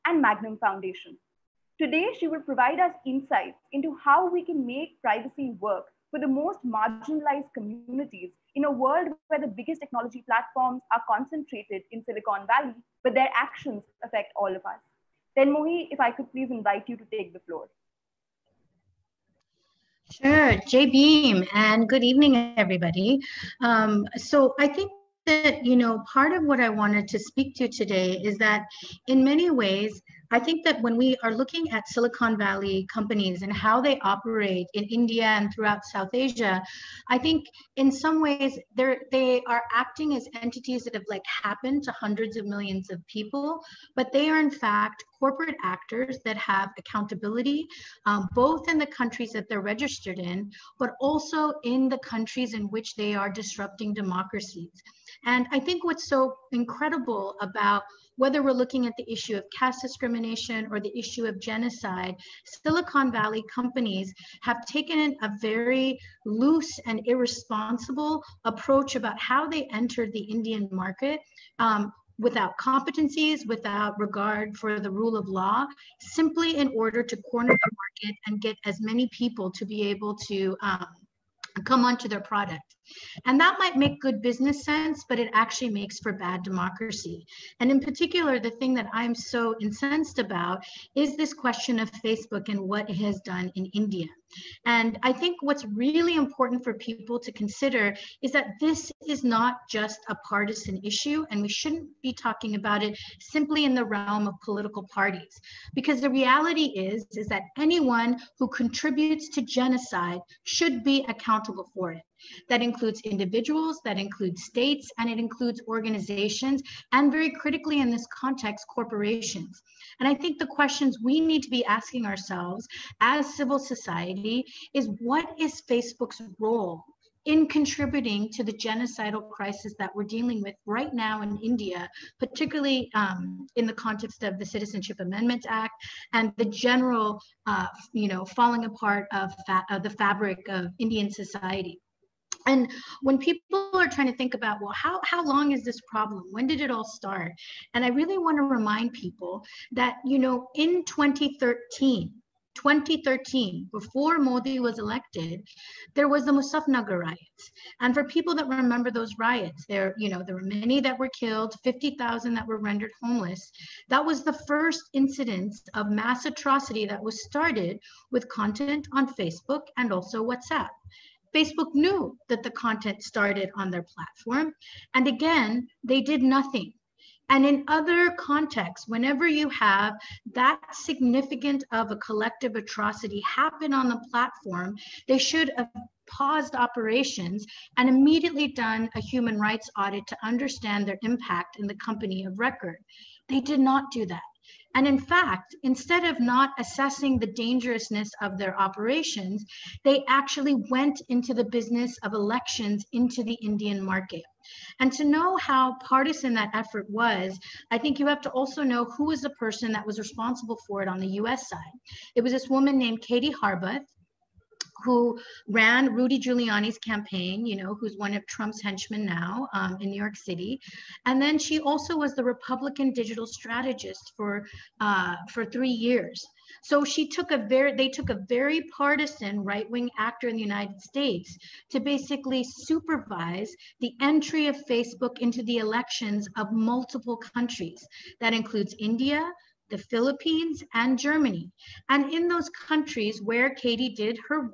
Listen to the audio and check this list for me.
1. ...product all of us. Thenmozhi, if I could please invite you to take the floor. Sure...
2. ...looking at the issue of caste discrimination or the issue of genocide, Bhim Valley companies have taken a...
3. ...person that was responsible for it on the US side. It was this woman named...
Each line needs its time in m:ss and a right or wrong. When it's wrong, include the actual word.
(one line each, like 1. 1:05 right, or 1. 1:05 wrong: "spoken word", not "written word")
1. 0:14 wrong: "affect", not "product"
2. 0:58 wrong: "Silicon", not "Bhim"
3. 3:29 right.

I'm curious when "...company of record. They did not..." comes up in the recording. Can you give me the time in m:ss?
3:11.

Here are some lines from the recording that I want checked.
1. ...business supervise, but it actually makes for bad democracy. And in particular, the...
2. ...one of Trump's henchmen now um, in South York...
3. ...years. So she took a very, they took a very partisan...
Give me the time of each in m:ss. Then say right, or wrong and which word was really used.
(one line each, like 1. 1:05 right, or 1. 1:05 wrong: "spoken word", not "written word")
1. 1:24 wrong: "sense", not "supervise"
2. 3:37 wrong: "New", not "South"
3. 3:45 right.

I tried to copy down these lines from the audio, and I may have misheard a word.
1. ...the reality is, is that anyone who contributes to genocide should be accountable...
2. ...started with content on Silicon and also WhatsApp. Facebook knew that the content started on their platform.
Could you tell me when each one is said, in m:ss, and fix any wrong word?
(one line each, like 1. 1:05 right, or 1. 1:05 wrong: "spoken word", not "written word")
1. 1:46 right
2. 2:47 wrong: "Facebook", not "Silicon".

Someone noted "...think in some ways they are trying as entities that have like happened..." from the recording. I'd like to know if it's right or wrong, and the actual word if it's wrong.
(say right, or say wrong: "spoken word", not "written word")
wrong: "acting", not "trying".